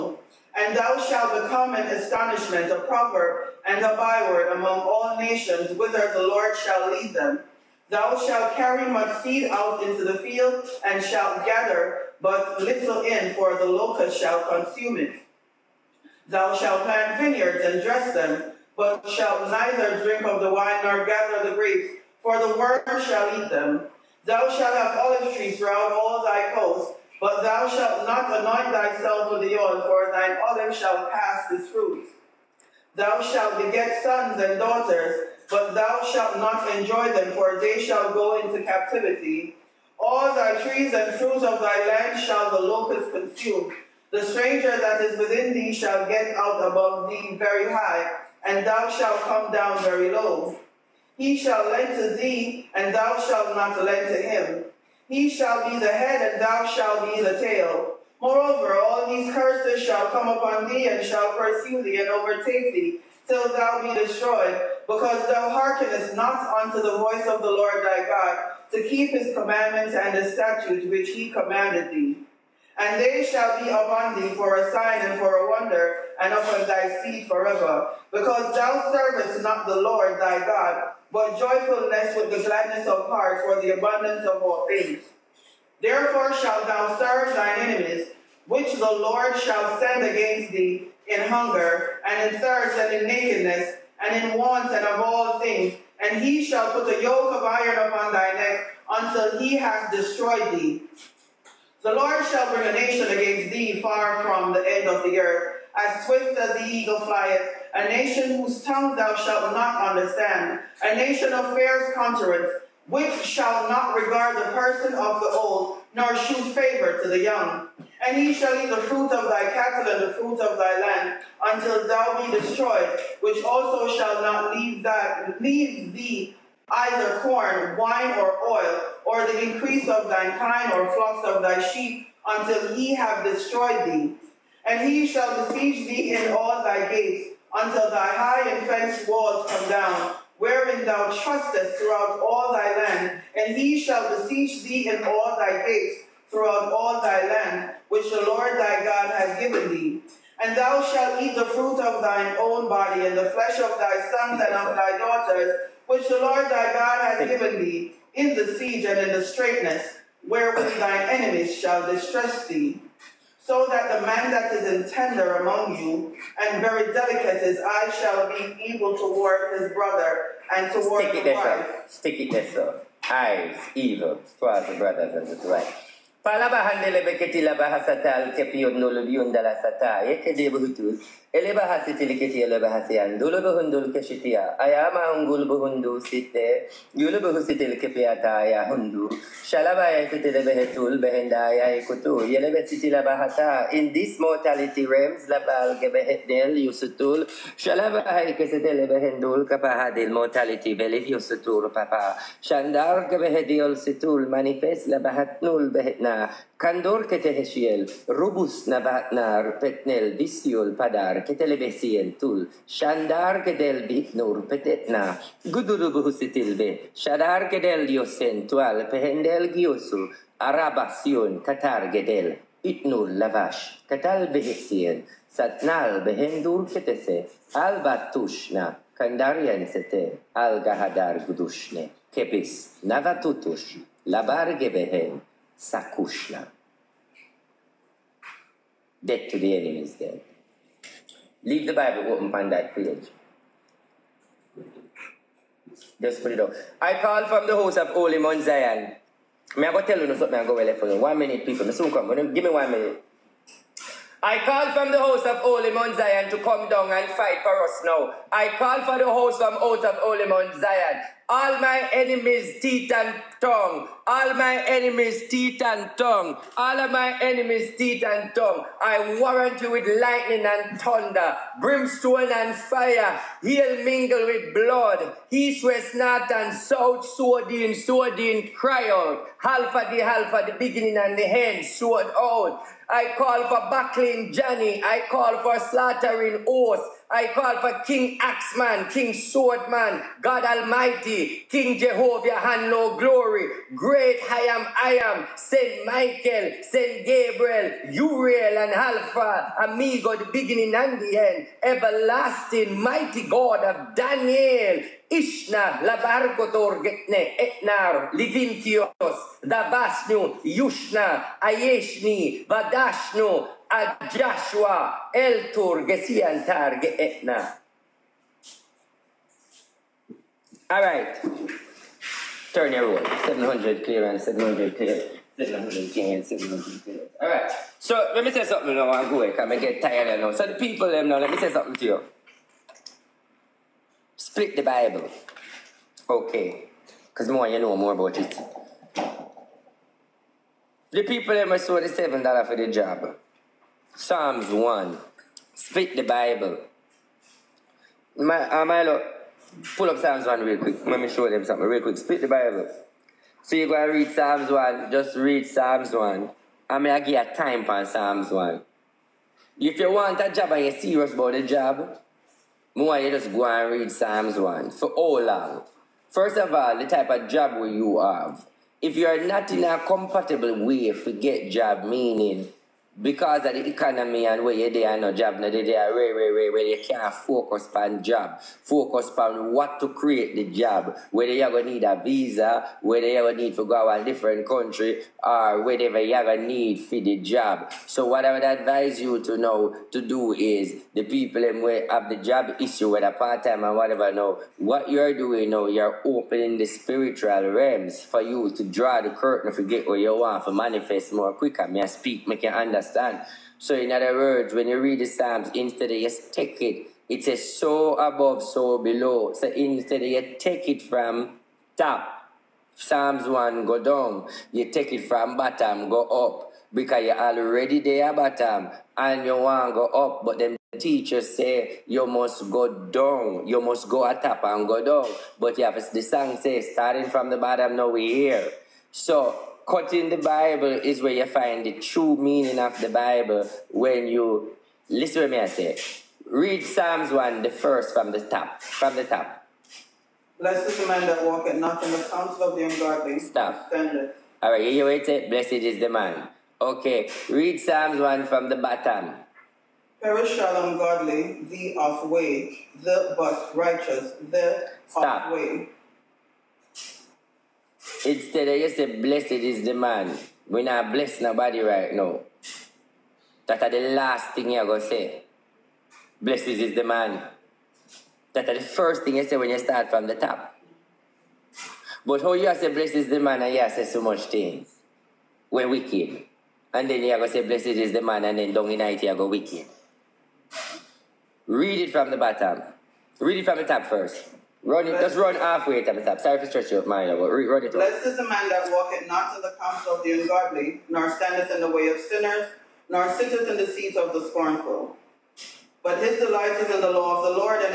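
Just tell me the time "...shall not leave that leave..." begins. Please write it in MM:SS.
02:03.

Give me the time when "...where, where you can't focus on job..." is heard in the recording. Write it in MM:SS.
06:16.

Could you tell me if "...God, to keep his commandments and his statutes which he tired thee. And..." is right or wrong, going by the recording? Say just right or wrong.
wrong.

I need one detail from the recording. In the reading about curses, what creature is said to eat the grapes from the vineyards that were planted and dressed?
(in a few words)
the worm.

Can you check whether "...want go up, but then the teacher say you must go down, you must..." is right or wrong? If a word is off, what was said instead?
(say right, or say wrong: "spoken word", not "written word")
right.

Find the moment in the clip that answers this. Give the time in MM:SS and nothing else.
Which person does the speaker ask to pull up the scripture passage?
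05:48.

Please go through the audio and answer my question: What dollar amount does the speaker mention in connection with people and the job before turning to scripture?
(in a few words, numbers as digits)
$7.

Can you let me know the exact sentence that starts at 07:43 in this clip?
That the last thing you gonna say.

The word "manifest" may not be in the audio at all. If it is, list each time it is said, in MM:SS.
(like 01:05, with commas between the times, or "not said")
03:24, 06:40.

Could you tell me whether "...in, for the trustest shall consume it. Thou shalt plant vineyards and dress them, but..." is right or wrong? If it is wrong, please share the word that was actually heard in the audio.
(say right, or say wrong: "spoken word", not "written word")
wrong: "locust", not "trustest".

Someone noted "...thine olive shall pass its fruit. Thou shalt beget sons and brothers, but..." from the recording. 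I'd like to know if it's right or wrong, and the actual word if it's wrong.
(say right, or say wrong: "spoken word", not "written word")
wrong: "daughters", not "brothers".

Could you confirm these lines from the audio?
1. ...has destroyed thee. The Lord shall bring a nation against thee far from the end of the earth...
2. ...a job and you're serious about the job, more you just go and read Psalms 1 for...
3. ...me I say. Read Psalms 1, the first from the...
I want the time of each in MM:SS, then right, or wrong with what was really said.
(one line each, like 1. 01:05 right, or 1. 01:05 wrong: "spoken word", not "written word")
1. 01:39 right
2. 06:00 right
3. 07:15 right.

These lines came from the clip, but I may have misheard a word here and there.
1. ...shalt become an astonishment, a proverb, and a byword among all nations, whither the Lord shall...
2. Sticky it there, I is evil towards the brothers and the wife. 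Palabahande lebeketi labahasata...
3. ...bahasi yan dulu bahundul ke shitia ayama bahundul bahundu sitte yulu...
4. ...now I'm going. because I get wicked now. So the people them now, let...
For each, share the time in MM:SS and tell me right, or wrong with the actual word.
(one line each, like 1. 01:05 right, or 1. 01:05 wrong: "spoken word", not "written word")
1. 00:00 right
2. 02:51 right
3. 03:02 wrong: "ungul", not "bahundul"
4. 05:28 wrong: "tired", not "wicked".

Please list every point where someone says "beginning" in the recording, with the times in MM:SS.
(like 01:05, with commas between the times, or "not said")
04:40, 05:00.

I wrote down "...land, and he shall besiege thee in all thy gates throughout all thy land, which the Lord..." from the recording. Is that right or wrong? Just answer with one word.
right.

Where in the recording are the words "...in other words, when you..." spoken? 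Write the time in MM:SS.
06:43.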